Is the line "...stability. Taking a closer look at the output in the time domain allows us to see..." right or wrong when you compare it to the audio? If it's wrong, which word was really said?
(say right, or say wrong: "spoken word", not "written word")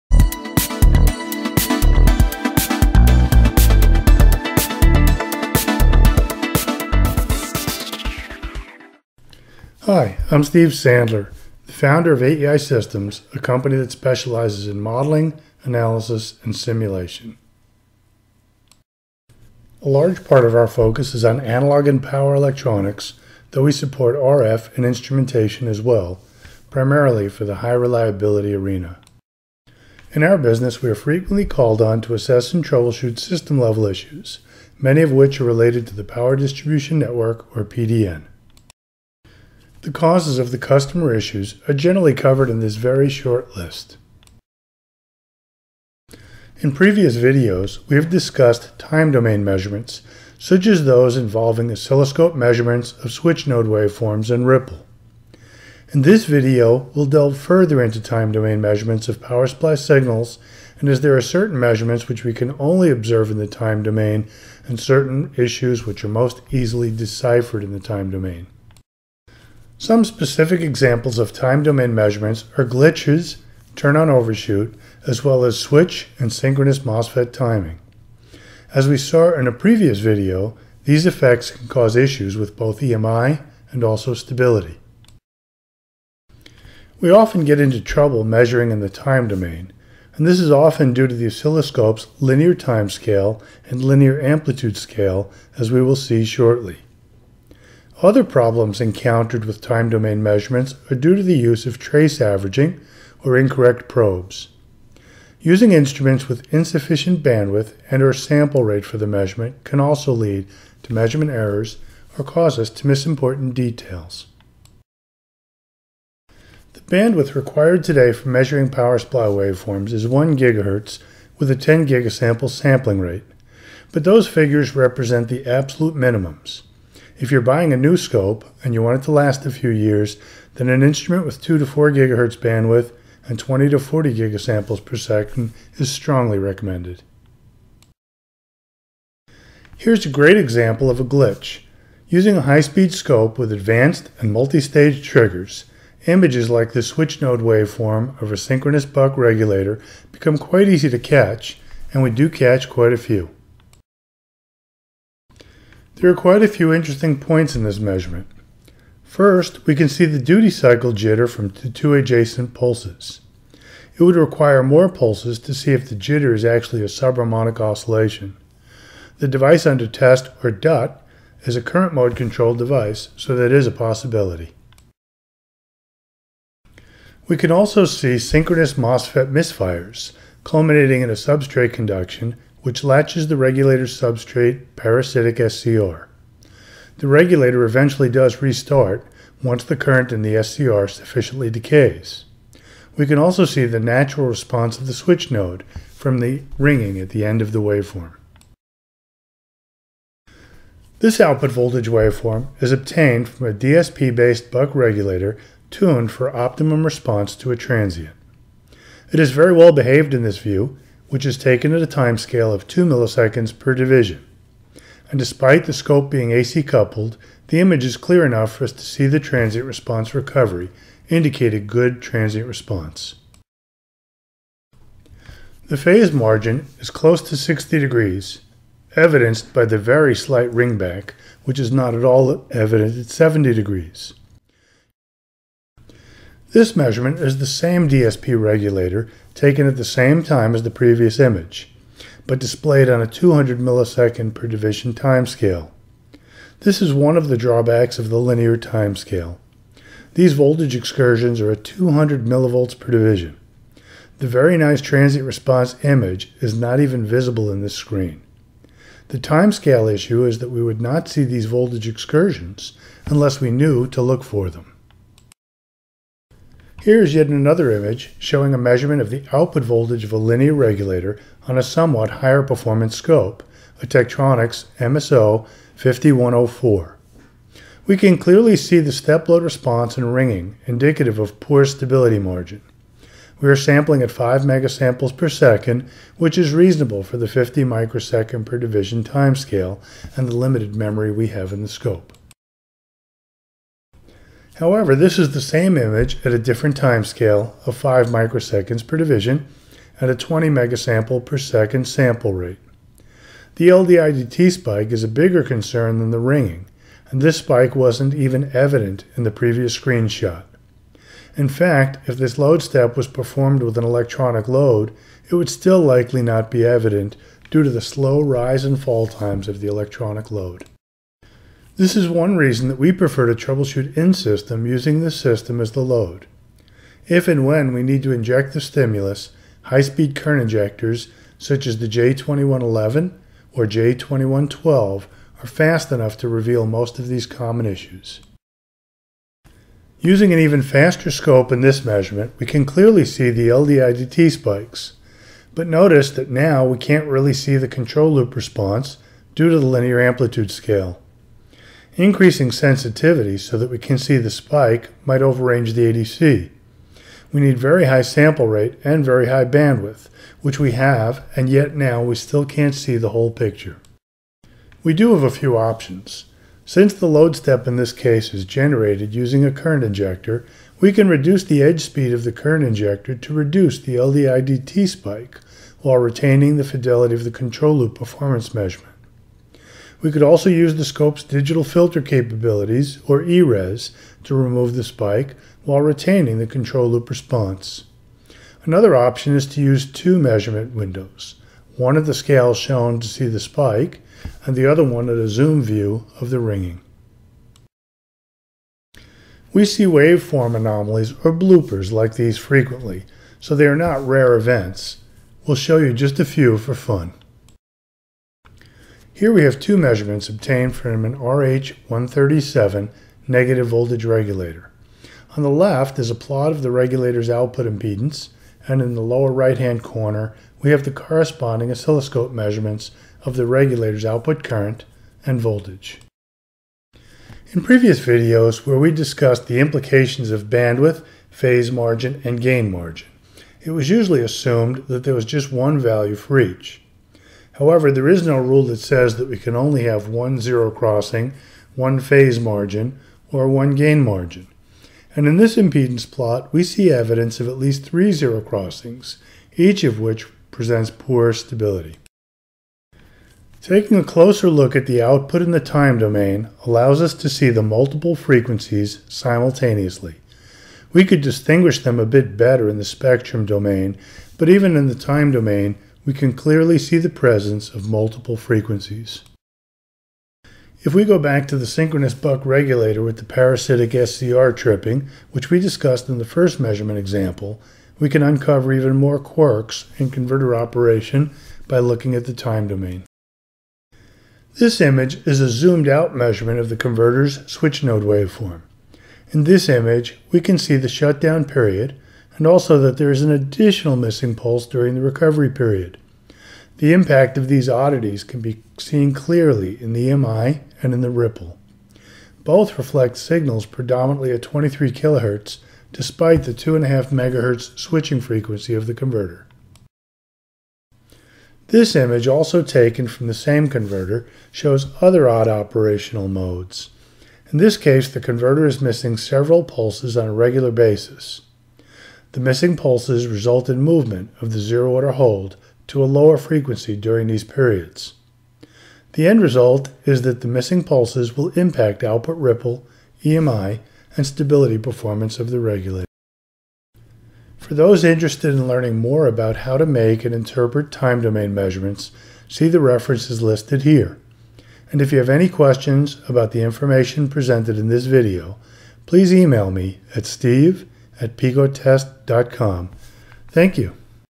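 right.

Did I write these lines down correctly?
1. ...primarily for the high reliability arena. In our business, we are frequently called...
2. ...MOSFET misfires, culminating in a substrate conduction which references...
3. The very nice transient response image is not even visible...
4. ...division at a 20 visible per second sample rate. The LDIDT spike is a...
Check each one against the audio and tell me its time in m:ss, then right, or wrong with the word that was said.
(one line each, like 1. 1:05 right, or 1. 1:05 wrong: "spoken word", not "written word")
1. 0:26 right
2. 2:58 wrong: "latches", not "references"
3. 4:14 right
4. 4:58 wrong: "megasample", not "visible".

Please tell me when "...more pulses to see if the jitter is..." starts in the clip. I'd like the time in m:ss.
2:44.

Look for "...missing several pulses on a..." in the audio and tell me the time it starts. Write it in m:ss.
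8:38.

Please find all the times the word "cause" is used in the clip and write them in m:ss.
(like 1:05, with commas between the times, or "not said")
0:39, 1:21, 1:52.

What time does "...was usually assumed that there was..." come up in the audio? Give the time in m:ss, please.
7:13.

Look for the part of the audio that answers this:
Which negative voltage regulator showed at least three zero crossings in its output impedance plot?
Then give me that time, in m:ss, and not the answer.
6:51.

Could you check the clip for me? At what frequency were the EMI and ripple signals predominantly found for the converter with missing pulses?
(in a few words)
23 kHz.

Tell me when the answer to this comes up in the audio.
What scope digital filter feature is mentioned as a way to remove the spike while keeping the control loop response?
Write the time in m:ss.
6:23.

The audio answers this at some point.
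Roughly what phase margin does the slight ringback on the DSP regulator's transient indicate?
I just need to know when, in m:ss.
3:47.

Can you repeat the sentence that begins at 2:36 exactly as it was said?
There are quite a few interesting points in this measurement.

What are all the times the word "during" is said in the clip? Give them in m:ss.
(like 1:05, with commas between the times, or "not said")
8:14, 8:46.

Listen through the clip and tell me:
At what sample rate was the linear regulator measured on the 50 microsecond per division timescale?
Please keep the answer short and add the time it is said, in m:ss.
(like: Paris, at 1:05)
5 megasamples per second, at 4:44.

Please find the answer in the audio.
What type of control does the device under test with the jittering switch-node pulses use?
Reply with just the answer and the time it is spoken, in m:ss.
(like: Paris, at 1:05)
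current mode, at 2:51.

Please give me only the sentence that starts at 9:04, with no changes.
And if you have any questions about the information presented in this video, please email me at steve at picotest.com.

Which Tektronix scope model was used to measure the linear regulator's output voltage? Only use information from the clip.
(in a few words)
MSO 5104.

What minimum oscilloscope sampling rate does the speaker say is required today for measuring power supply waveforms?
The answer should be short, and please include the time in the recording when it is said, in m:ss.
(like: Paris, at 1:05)
10 gigasamples, at 2:01.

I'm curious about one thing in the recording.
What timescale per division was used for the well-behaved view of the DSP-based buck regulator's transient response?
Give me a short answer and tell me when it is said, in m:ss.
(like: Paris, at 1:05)
2 milliseconds, at 3:32.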